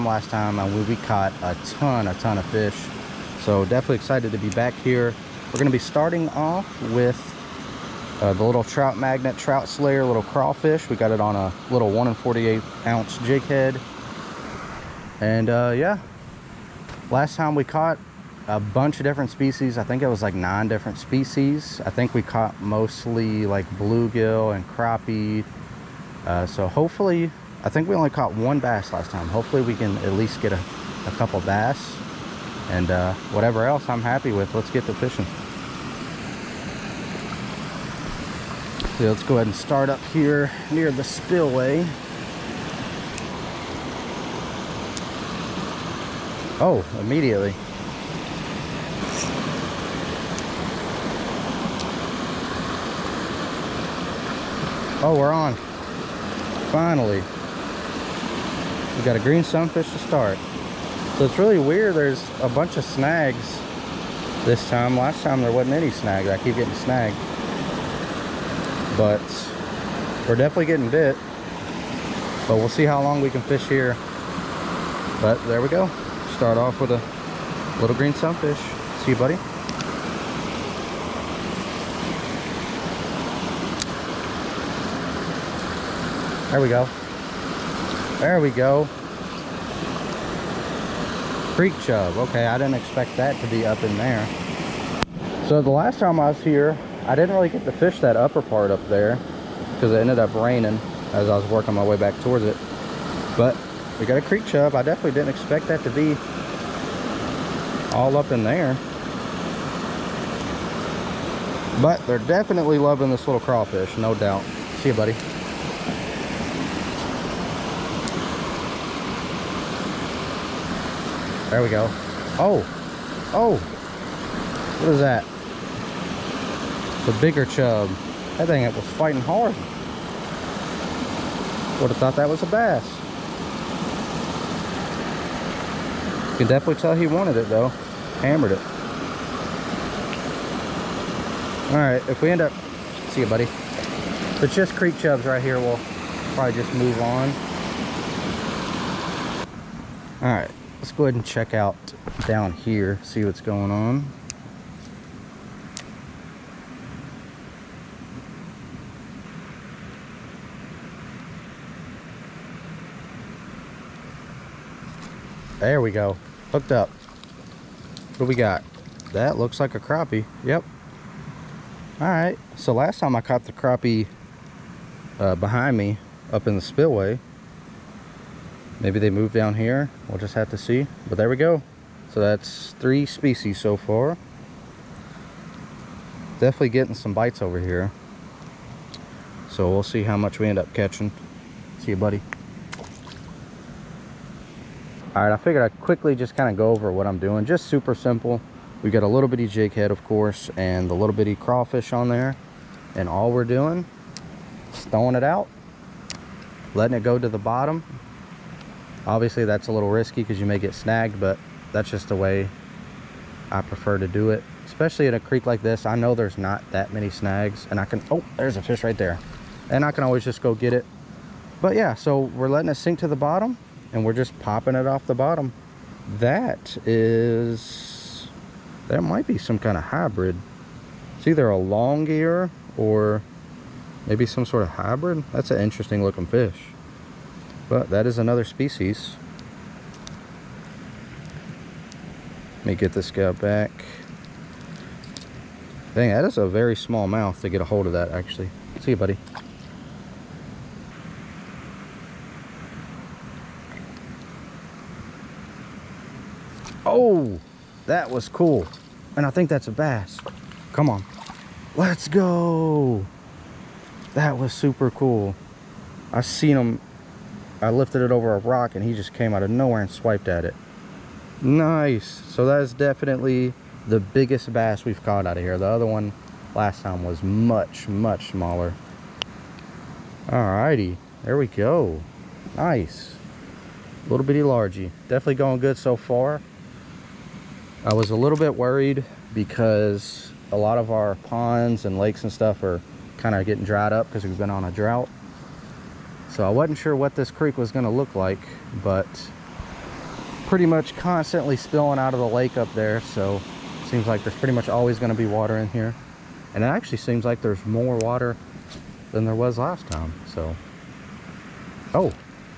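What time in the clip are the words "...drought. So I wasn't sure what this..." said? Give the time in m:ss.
4:54.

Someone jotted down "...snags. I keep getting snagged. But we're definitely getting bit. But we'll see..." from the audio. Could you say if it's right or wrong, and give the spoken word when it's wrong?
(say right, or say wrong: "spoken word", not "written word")
right.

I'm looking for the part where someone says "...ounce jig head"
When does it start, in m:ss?
0:12.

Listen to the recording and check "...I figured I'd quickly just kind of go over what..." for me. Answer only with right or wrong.
right.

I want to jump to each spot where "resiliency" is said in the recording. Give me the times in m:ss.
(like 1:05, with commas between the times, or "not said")
not said.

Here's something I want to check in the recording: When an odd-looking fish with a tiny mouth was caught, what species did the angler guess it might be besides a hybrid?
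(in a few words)
Long ear.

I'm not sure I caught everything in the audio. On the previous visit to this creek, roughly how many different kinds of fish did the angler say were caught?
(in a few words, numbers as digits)
9.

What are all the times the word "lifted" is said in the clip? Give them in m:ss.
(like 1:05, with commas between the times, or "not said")
4:27.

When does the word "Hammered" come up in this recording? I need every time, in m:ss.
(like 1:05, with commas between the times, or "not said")
2:18.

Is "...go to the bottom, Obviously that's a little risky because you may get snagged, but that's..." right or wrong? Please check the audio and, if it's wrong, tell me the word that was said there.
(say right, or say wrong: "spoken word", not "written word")
right.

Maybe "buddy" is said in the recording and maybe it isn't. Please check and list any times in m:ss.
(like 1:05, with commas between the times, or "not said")
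1:19, 1:54, 2:23, 3:11, 4:08.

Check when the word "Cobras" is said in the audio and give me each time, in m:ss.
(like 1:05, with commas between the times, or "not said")
not said.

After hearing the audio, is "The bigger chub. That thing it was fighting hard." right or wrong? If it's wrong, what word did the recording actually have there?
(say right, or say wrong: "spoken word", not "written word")
right.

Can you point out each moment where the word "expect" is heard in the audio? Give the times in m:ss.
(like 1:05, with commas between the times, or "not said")
1:32, 1:45.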